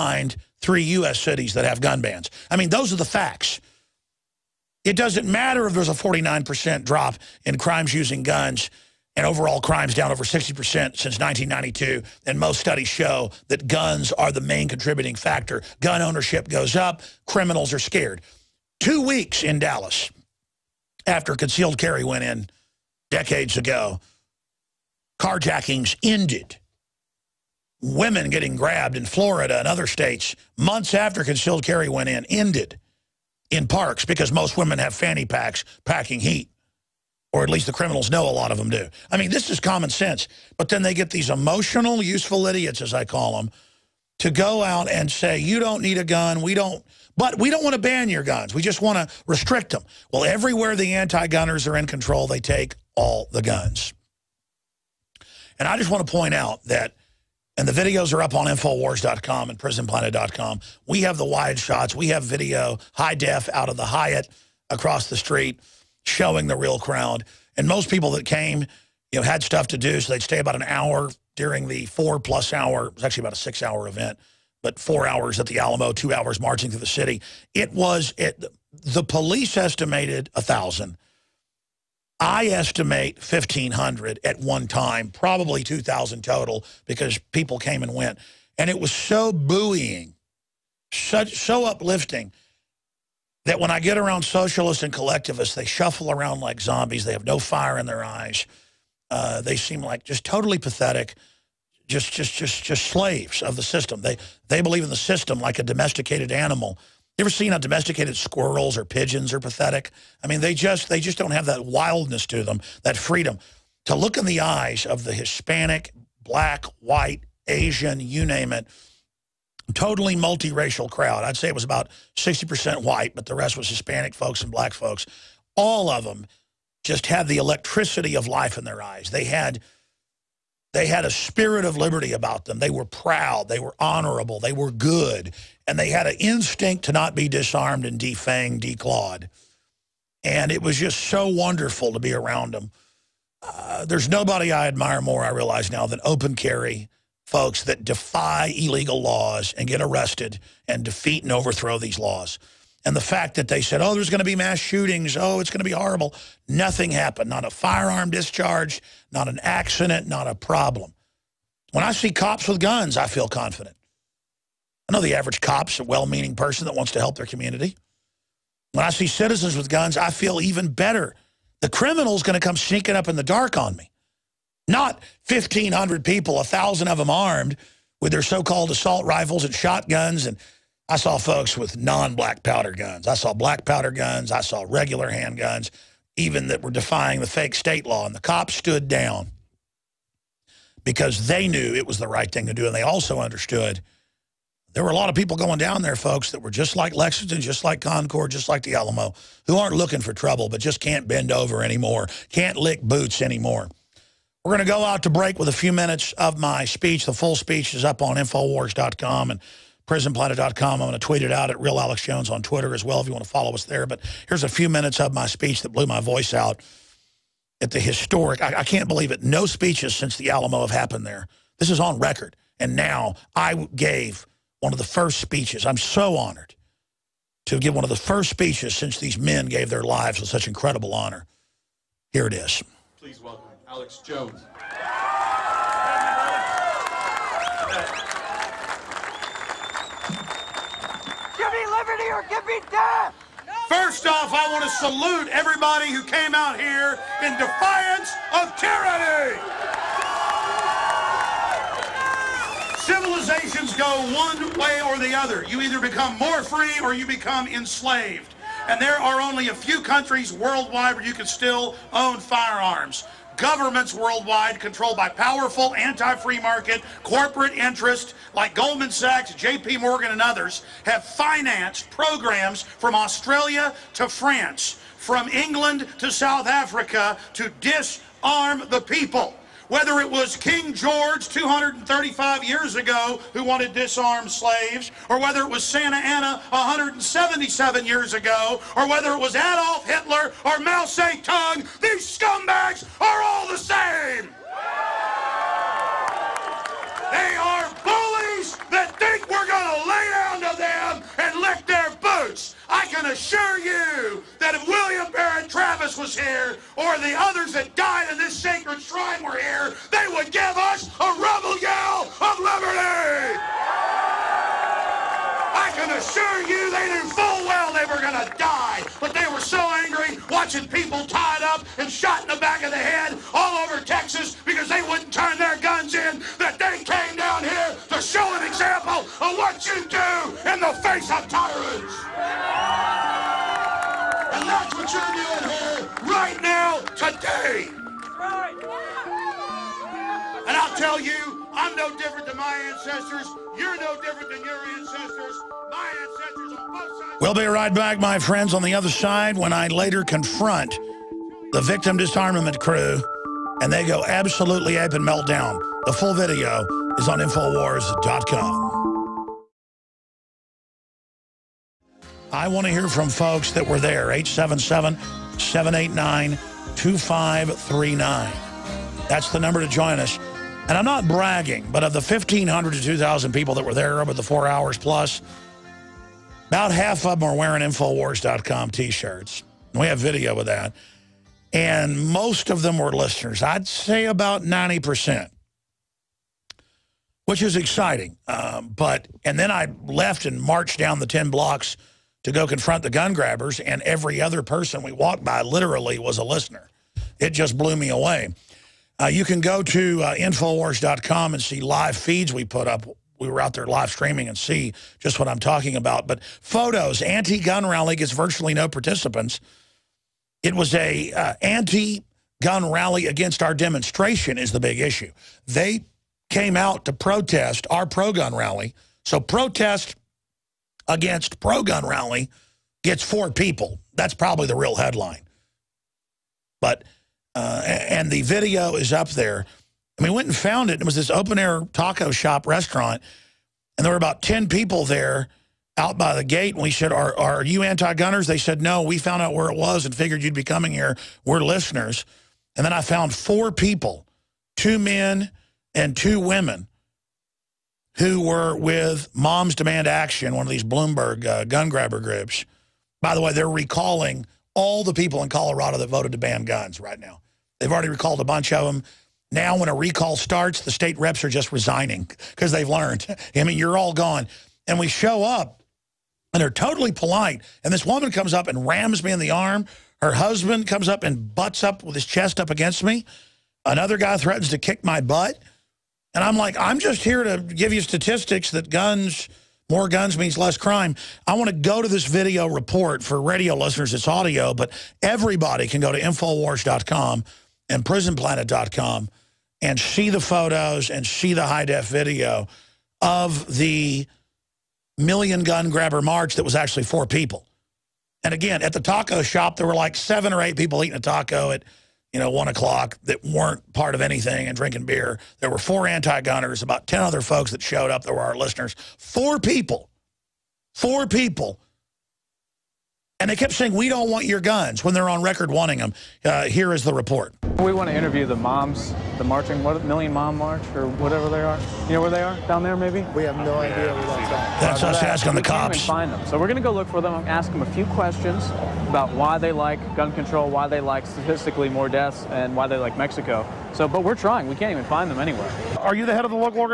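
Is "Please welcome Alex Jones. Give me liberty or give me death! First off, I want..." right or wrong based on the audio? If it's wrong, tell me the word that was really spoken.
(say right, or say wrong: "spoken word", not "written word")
right.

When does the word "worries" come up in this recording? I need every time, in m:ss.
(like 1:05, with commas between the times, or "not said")
not said.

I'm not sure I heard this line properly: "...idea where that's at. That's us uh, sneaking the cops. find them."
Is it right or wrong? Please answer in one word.
wrong.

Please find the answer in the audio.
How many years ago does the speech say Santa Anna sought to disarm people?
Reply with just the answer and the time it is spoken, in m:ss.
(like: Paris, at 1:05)
177, at 4:46.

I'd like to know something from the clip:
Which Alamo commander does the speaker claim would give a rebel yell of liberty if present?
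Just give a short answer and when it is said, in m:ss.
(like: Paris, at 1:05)
William Barret Travis, at 5:04.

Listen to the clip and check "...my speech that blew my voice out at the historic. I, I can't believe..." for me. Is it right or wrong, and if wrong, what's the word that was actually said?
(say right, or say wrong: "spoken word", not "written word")
right.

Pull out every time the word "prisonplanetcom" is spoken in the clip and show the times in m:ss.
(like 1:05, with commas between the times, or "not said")
0:59, 3:29, 8:07.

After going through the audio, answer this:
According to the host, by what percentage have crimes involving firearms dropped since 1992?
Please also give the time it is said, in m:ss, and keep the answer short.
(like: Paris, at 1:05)
49%, at 0:05.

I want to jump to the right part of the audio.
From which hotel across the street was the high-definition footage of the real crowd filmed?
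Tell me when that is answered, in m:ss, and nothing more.
1:03.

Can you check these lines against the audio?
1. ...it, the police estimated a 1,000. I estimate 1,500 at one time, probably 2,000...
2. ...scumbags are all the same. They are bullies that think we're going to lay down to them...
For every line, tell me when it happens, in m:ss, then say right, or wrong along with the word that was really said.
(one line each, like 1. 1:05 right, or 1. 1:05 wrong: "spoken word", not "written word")
1. 1:18 right
2. 4:52 right.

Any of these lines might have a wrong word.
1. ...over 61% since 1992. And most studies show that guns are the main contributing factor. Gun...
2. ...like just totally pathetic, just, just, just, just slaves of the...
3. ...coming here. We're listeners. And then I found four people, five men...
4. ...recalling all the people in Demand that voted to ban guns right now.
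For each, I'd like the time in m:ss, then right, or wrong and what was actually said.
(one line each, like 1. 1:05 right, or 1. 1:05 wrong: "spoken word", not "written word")
1. 0:10 wrong: "60", not "61"
2. 1:39 right
3. 7:20 wrong: "two", not "five"
4. 7:33 wrong: "Colorado", not "Demand".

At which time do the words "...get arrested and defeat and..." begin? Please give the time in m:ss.
2:29.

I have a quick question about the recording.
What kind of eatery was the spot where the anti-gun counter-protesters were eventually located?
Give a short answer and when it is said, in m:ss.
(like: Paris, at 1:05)
open-air taco shop, at 7:11.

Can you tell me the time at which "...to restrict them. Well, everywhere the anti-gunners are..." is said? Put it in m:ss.
0:48.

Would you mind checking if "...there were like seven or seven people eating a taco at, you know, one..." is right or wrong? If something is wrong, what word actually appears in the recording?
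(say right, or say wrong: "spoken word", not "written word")
wrong: "eight", not "seven".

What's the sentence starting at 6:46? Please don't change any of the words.
But photos, anti-gun rally gets virtually no participants.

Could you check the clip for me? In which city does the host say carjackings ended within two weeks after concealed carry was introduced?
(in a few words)
Dallas.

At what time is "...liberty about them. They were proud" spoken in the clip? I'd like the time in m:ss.
2:11.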